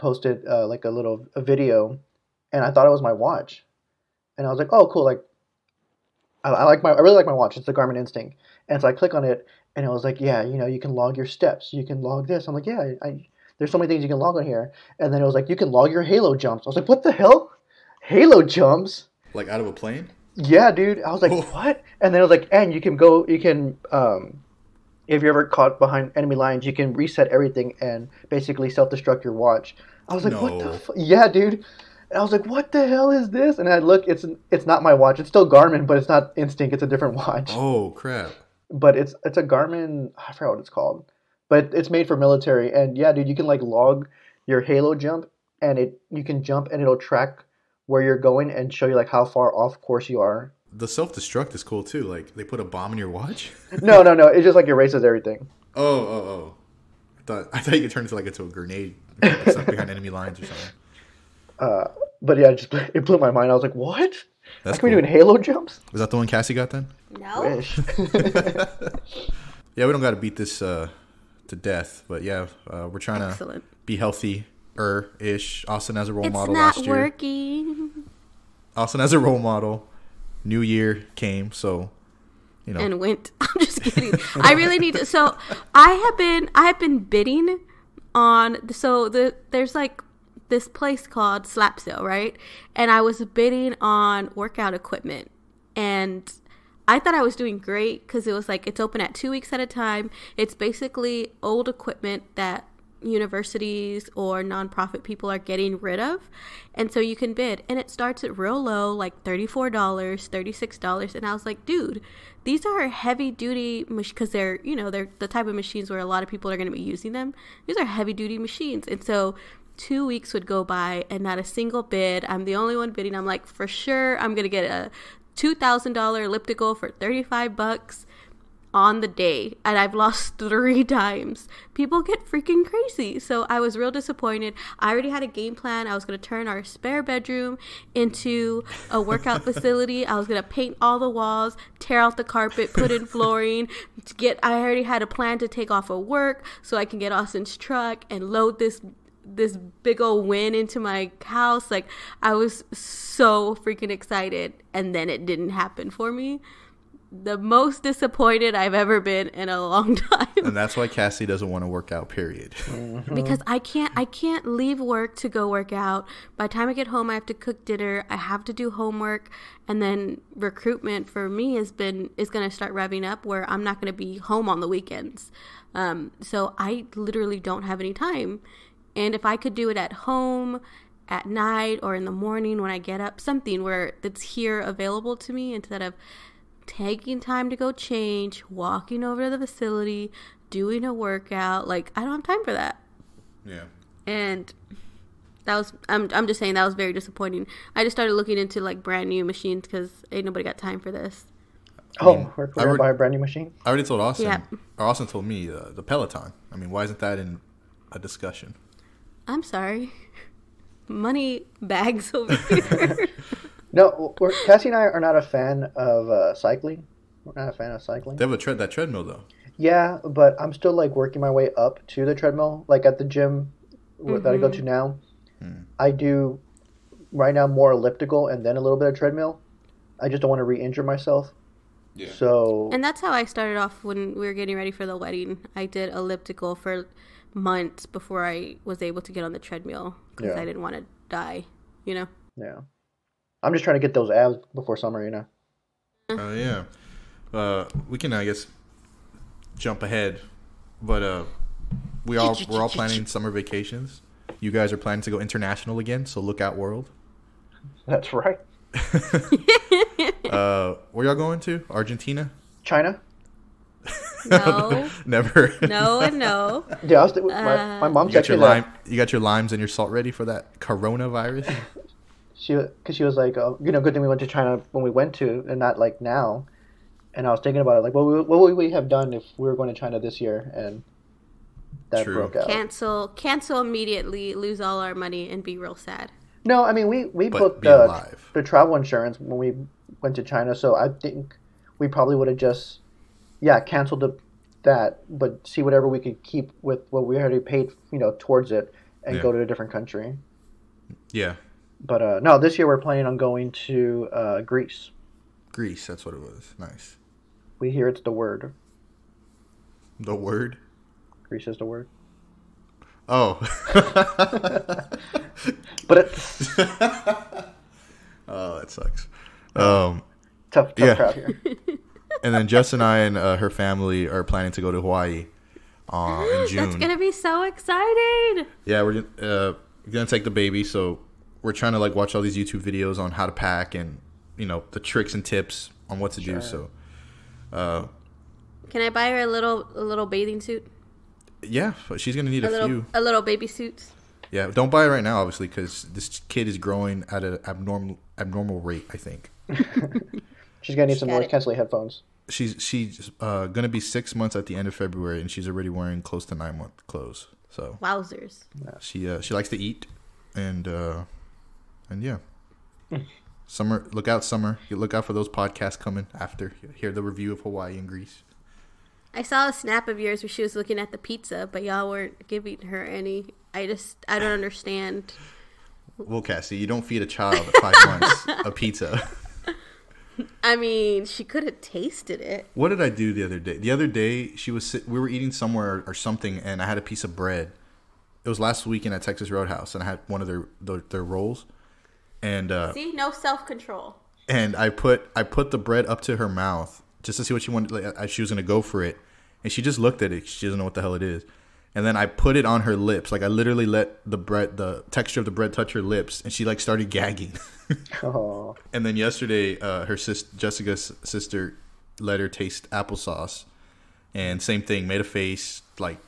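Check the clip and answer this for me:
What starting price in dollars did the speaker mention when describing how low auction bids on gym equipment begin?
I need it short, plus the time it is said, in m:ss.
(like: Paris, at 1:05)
$34, at 1:49.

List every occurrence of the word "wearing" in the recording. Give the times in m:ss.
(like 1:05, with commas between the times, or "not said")
5:55.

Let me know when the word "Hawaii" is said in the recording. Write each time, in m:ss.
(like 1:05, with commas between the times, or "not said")
5:24, 6:07.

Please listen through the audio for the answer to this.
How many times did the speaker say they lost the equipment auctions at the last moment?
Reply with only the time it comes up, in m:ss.
2:10.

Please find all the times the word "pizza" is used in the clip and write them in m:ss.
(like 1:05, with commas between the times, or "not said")
6:10, 6:18.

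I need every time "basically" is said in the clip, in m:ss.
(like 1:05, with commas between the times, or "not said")
0:28, 1:40.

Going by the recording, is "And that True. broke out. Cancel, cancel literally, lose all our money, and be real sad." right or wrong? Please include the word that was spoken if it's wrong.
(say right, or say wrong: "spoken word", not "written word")
wrong: "immediately", not "literally".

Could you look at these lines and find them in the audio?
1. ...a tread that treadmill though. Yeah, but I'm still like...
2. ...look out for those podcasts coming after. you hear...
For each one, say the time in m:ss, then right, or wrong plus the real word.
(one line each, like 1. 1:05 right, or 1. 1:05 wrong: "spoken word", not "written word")
1. 3:38 right
2. 6:04 right.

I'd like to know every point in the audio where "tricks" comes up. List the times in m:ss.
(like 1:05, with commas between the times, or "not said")
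5:34.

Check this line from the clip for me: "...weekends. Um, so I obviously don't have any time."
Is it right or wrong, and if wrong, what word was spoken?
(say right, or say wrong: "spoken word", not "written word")
wrong: "literally", not "obviously".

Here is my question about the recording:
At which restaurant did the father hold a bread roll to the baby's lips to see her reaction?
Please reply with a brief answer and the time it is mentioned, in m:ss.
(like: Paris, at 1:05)
Texas Roadhouse, at 6:29.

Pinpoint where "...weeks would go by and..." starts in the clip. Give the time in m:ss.
2:00.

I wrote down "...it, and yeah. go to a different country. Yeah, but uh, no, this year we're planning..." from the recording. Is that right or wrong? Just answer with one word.
right.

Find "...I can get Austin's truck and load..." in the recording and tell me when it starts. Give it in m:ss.
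2:26.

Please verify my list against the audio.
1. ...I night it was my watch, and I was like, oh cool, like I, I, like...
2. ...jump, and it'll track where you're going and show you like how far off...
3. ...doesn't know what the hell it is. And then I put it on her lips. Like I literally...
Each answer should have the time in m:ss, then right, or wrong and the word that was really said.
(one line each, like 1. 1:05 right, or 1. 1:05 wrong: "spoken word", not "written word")
1. 0:02 wrong: "thought", not "night"
2. 0:46 right
3. 6:40 right.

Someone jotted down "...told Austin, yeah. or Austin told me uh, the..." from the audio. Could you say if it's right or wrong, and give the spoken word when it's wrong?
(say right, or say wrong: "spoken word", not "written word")
right.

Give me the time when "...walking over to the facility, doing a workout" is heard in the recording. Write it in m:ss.
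3:08.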